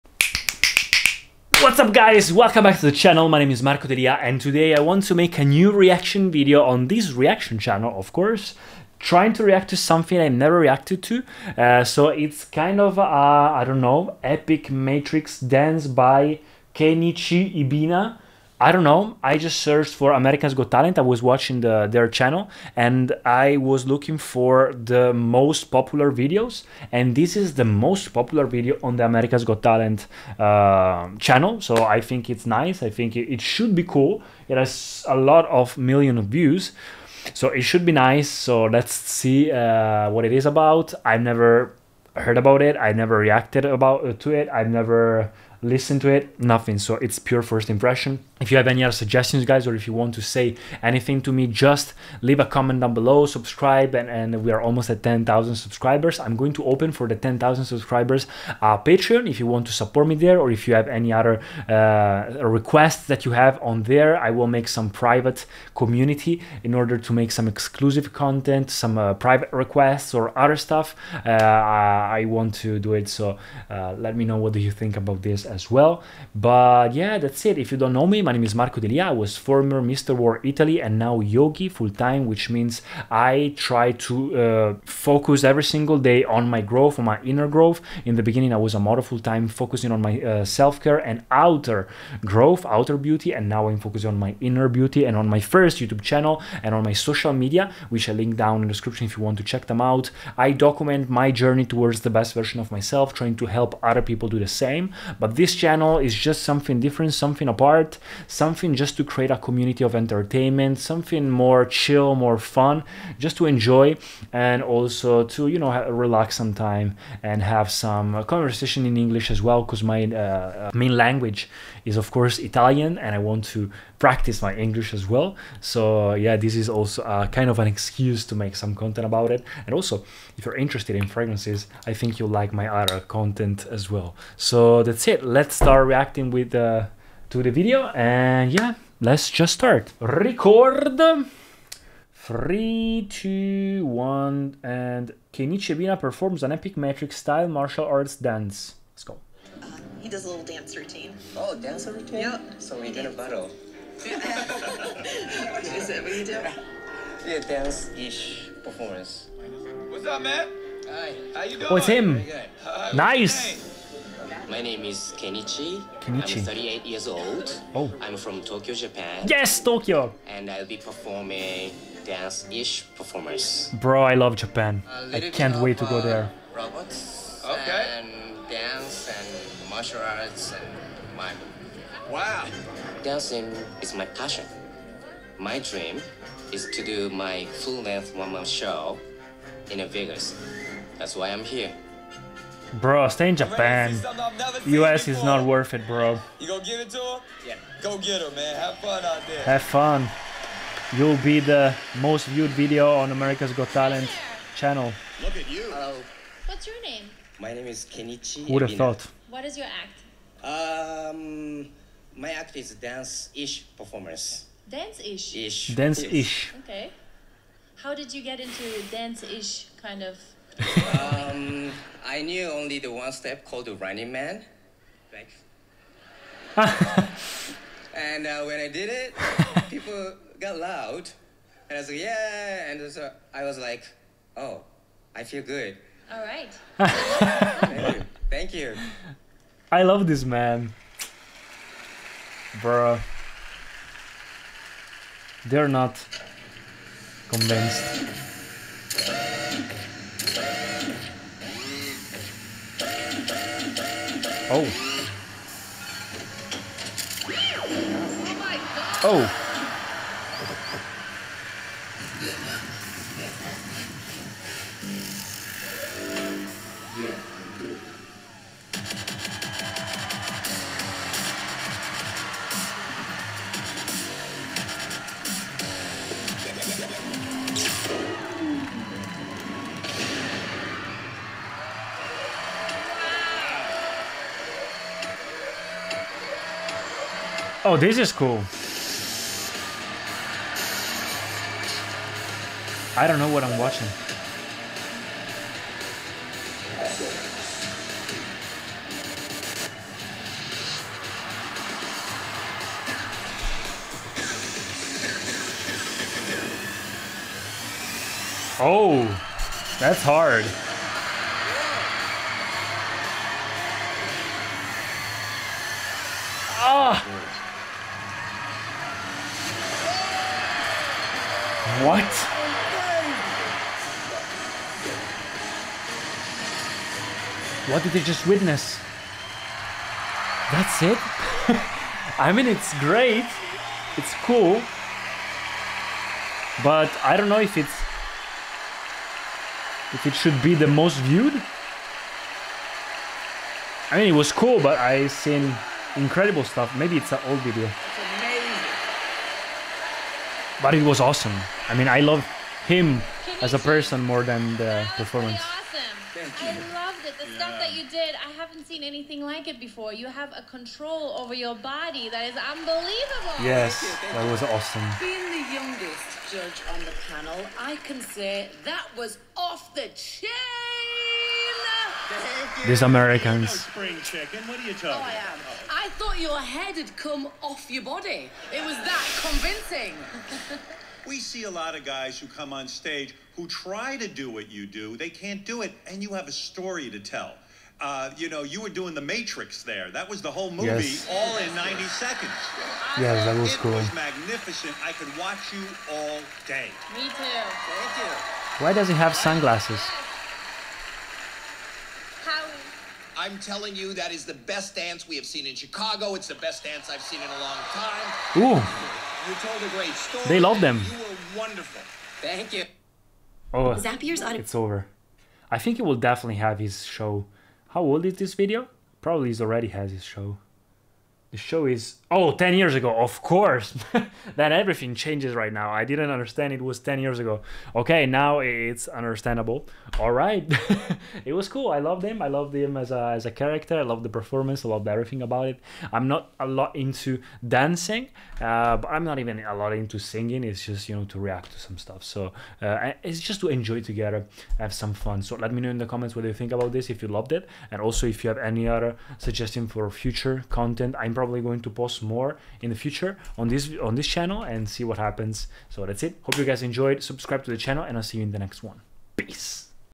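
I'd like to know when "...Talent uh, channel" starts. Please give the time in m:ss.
0:29.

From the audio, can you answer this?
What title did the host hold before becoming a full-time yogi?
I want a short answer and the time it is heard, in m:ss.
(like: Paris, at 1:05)
Mr. World Italy, at 1:19.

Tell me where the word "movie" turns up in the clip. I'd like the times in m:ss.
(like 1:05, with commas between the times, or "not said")
6:30.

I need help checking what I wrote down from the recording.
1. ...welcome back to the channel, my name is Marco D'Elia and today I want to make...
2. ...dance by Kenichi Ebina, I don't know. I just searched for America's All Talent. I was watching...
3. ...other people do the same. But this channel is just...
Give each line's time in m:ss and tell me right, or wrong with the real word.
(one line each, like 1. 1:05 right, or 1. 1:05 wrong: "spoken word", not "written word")
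1. 0:02 right
2. 0:15 wrong: "Got", not "All"
3. 1:43 right.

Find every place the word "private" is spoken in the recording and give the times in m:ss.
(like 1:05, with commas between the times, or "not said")
1:04, 1:09.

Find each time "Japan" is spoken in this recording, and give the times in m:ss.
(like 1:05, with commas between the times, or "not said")
2:48, 2:54, 3:13.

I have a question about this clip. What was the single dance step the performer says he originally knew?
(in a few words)
Running Man.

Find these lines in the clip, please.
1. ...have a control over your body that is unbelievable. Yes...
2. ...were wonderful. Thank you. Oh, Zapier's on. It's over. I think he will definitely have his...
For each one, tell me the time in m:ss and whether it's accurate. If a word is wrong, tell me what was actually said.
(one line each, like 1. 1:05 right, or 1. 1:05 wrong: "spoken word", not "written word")
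1. 6:00 right
2. 6:50 right.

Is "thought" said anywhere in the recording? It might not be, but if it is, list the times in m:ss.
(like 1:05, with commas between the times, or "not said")
3:28, 6:15.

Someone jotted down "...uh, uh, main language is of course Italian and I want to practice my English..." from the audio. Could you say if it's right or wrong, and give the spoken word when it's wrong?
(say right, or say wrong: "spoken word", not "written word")
right.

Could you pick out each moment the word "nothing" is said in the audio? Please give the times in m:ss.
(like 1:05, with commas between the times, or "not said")
0:46.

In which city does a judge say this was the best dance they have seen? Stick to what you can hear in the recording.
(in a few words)
Chicago.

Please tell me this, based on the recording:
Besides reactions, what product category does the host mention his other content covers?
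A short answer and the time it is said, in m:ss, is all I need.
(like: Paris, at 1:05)
Fragrances, at 2:11.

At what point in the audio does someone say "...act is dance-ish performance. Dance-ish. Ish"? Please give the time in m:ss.
3:32.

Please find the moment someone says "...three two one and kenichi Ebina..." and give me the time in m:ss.
2:22.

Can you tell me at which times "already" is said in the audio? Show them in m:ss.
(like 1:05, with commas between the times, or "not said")
6:59.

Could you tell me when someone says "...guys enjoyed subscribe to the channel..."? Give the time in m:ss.
7:36.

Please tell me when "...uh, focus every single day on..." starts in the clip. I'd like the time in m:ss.
1:24.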